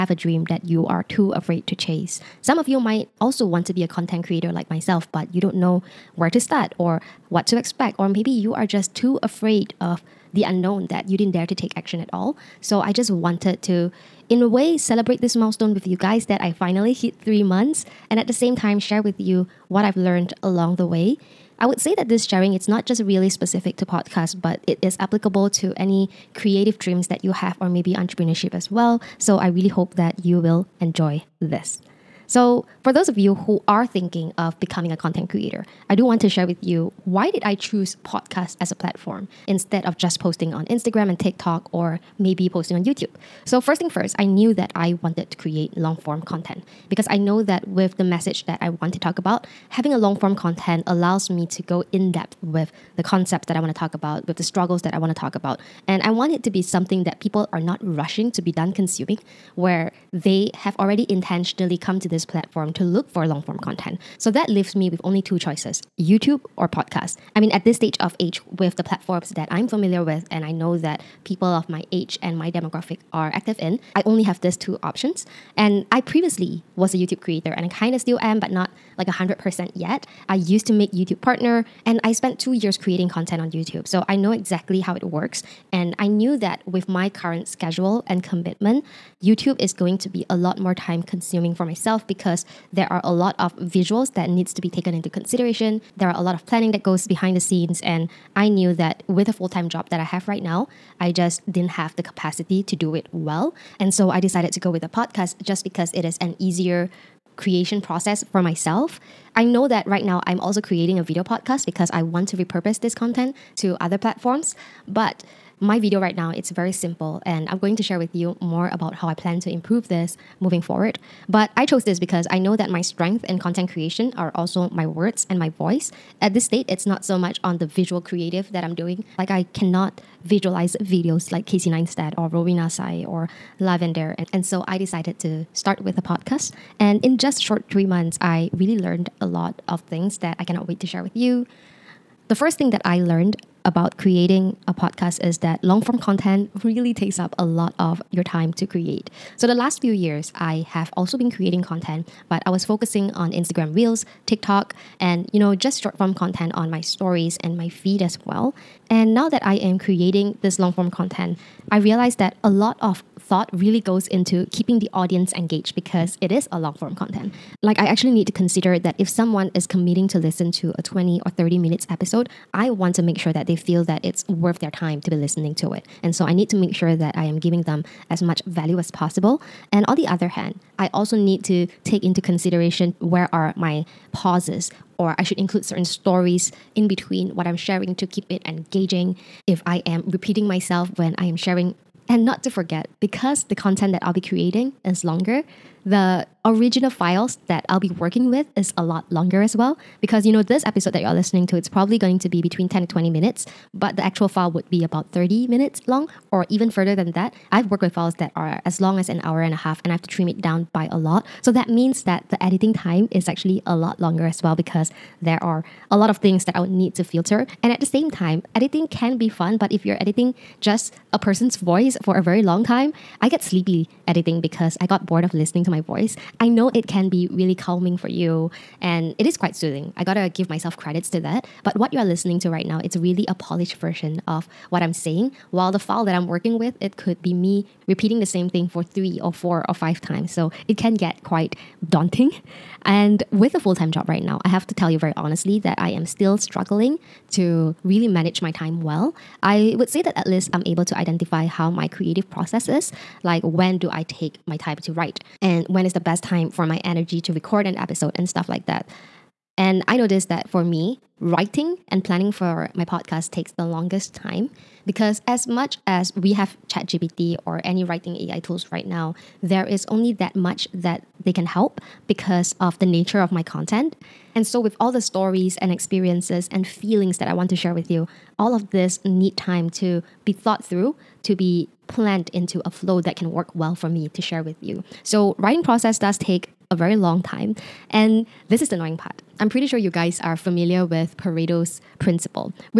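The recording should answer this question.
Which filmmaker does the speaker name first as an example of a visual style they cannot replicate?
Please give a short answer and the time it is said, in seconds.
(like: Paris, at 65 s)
Casey Neistat, at 131 s.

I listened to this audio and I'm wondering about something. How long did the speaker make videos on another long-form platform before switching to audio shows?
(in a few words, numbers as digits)
2 years.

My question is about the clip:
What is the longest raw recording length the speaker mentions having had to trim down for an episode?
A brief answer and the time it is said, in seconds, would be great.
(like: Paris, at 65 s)
an hour and a half, at 209 s.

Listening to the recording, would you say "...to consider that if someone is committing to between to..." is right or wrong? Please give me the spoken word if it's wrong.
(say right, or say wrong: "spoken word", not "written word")
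wrong: "listen", not "between".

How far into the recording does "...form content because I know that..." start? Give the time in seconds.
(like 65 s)
45 s.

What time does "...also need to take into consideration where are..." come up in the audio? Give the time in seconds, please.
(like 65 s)
180 s.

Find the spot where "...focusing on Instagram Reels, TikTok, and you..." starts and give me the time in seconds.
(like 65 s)
152 s.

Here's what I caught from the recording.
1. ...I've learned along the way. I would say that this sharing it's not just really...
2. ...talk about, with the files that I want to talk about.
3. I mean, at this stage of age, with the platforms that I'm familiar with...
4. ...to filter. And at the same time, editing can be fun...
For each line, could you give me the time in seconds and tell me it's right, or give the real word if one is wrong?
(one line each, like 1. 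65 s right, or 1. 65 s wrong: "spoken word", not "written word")
1. 19 s right
2. 53 s wrong: "struggles", not "files"
3. 67 s right
4. 216 s right.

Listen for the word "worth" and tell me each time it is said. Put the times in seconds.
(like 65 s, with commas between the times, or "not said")
174 s.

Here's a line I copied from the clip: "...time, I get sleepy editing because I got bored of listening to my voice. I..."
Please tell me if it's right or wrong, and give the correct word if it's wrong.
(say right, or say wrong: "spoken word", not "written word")
right.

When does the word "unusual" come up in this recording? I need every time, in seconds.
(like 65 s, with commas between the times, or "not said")
not said.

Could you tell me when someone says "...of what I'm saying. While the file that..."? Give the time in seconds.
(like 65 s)
234 s.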